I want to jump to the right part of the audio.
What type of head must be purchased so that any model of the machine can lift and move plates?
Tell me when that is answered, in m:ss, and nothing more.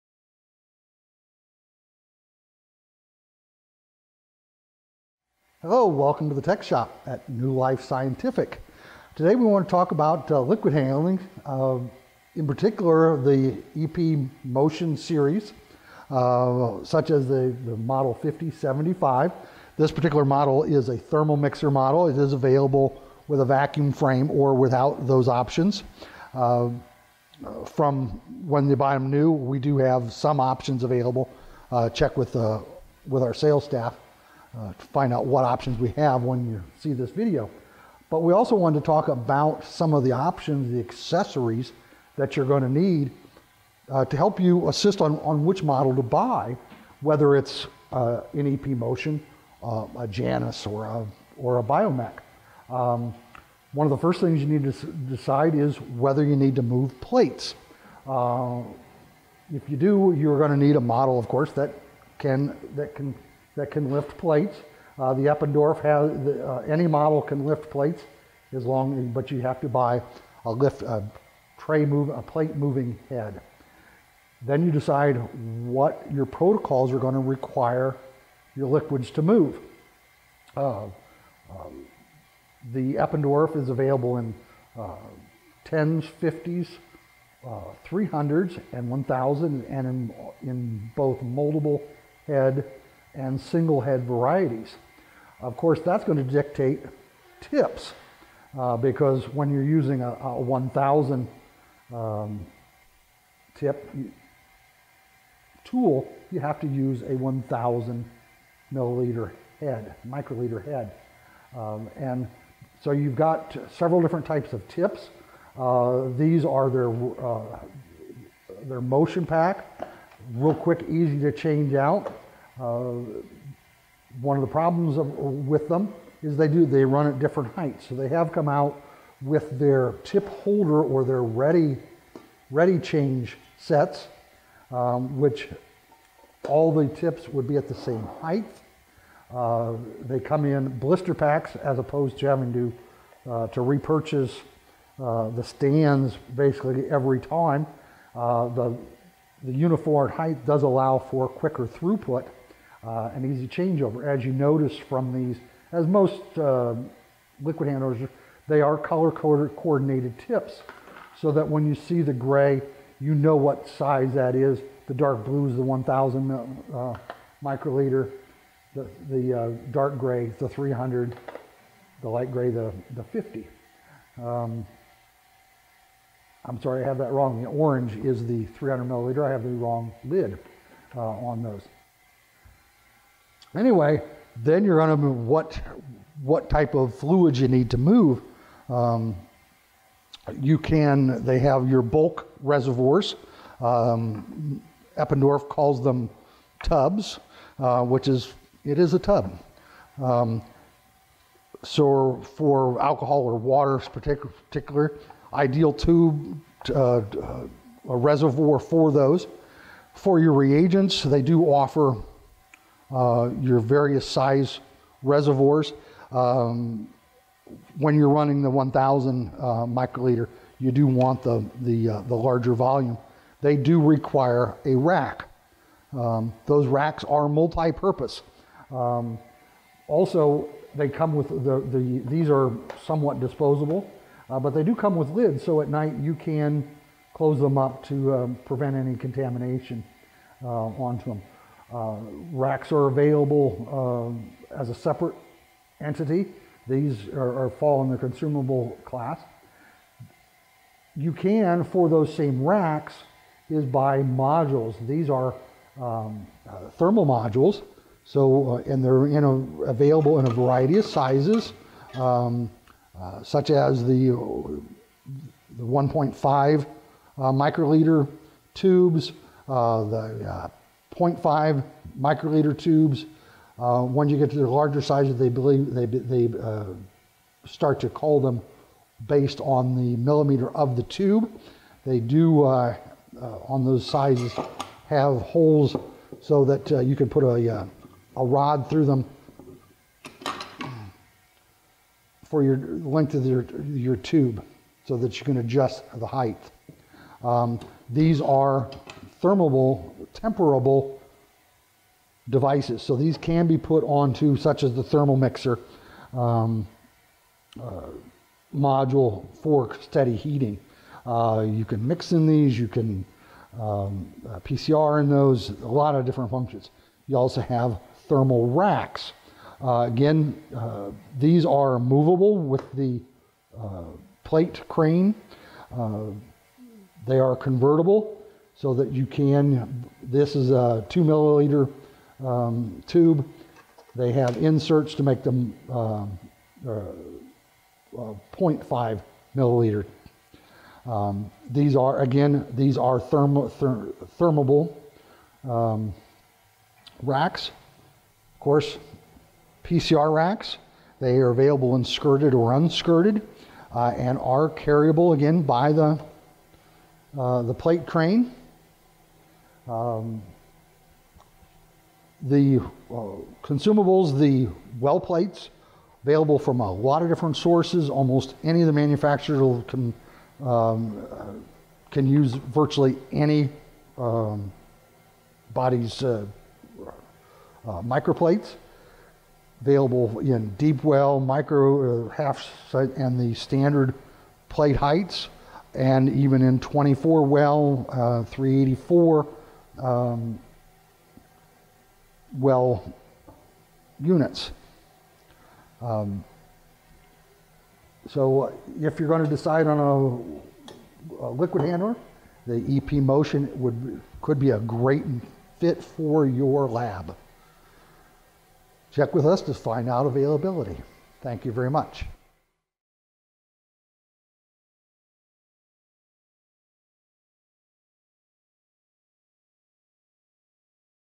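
1:12.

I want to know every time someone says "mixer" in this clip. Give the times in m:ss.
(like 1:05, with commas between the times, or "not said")
0:21, 5:05.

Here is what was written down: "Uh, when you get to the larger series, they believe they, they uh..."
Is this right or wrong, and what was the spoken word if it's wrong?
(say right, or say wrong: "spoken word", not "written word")
wrong: "sizes", not "series".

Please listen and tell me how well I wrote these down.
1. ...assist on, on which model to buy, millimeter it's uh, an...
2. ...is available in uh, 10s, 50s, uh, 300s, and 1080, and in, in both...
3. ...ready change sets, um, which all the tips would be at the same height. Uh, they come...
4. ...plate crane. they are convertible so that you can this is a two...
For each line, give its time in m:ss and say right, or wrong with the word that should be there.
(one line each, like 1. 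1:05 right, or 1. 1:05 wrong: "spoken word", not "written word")
1. 0:44 wrong: "whether", not "millimeter"
2. 1:23 wrong: "1000", not "1080"
3. 2:12 right
4. 5:24 right.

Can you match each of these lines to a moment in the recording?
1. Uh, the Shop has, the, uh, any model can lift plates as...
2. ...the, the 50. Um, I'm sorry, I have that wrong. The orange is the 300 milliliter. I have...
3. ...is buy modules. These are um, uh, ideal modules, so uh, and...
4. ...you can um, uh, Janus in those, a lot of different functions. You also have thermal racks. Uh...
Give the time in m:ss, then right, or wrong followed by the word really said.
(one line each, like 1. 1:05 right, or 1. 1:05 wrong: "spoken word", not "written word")
1. 1:04 wrong: "Eppendorf", not "Shop"
2. 2:52 right
3. 4:13 wrong: "thermal", not "ideal"
4. 5:12 wrong: "PCR", not "Janus".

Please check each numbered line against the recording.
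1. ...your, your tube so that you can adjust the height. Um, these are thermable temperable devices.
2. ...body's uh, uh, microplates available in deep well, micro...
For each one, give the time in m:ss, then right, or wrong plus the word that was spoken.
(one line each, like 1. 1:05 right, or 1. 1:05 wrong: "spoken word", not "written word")
1. 4:53 right
2. 6:15 right.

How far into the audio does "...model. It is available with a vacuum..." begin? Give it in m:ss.
0:21.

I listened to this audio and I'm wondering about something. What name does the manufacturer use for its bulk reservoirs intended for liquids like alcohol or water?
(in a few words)
tubs.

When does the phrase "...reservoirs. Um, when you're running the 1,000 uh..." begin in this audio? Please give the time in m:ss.
3:35.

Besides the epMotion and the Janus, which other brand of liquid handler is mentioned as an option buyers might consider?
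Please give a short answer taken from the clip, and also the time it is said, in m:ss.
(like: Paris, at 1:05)
Biomek, at 0:51.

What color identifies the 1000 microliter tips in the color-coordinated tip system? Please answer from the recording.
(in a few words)
dark blue.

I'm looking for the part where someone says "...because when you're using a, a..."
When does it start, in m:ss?
1:38.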